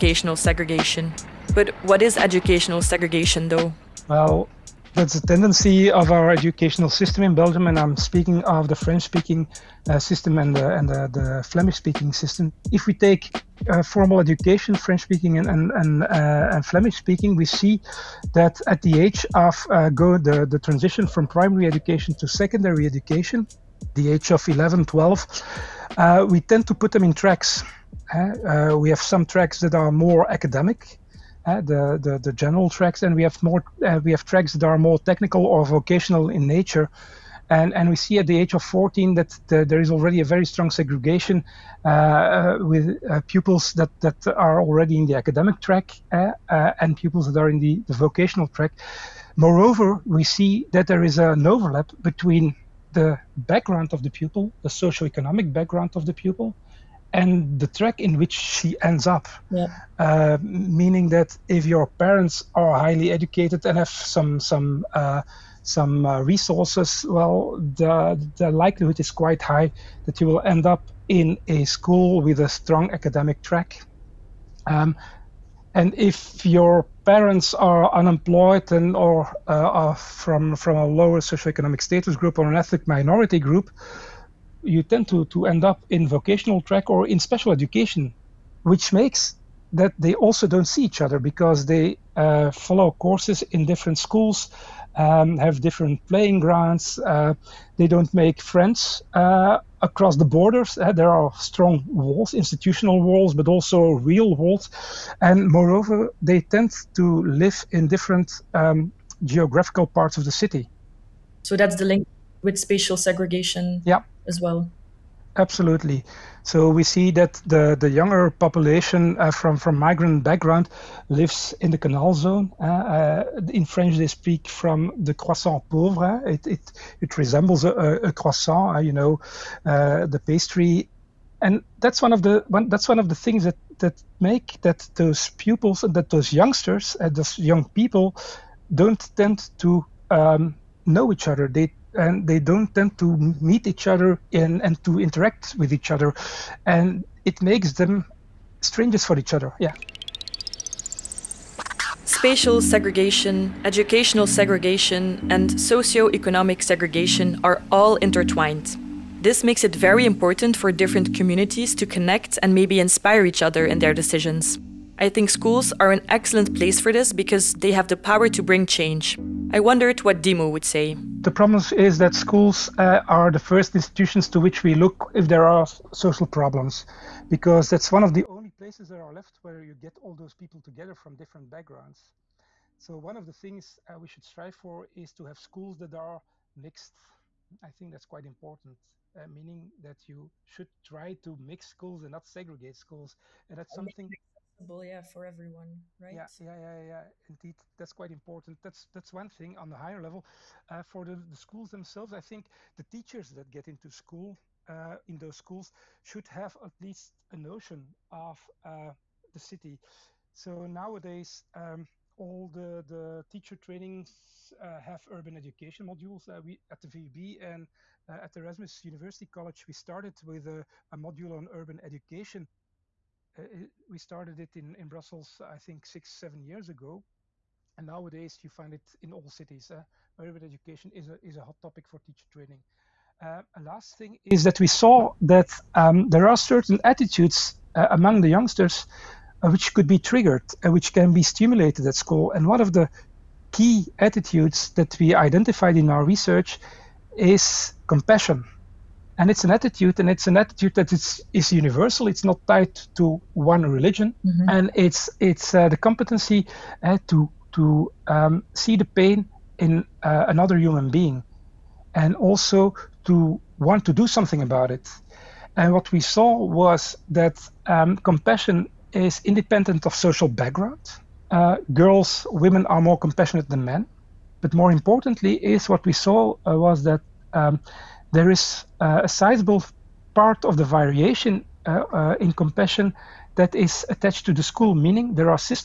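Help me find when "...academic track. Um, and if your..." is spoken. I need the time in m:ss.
1:12.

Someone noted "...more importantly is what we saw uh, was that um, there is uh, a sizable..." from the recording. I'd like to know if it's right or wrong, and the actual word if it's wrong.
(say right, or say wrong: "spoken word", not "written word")
right.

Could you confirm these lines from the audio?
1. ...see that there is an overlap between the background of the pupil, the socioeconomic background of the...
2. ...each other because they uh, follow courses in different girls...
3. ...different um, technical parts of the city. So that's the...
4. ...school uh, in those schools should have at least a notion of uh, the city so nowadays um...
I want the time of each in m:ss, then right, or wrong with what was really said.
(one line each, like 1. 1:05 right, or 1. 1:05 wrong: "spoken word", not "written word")
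1. 0:50 right
2. 1:30 wrong: "schools", not "girls"
3. 1:47 wrong: "geographical", not "technical"
4. 3:23 right.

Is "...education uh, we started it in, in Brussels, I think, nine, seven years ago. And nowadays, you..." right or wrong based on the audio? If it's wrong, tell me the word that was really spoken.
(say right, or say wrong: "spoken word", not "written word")
wrong: "six", not "nine".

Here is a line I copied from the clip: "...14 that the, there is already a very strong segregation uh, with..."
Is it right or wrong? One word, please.
right.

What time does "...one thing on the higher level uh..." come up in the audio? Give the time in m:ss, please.
3:19.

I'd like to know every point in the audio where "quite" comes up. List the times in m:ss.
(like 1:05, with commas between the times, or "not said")
1:09, 3:08, 3:17.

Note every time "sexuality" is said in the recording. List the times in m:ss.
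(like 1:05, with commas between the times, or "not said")
not said.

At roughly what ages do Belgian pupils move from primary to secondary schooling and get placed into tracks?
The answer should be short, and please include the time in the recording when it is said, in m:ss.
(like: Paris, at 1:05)
11, 12, at 0:23.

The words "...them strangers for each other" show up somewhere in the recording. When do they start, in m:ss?
2:27.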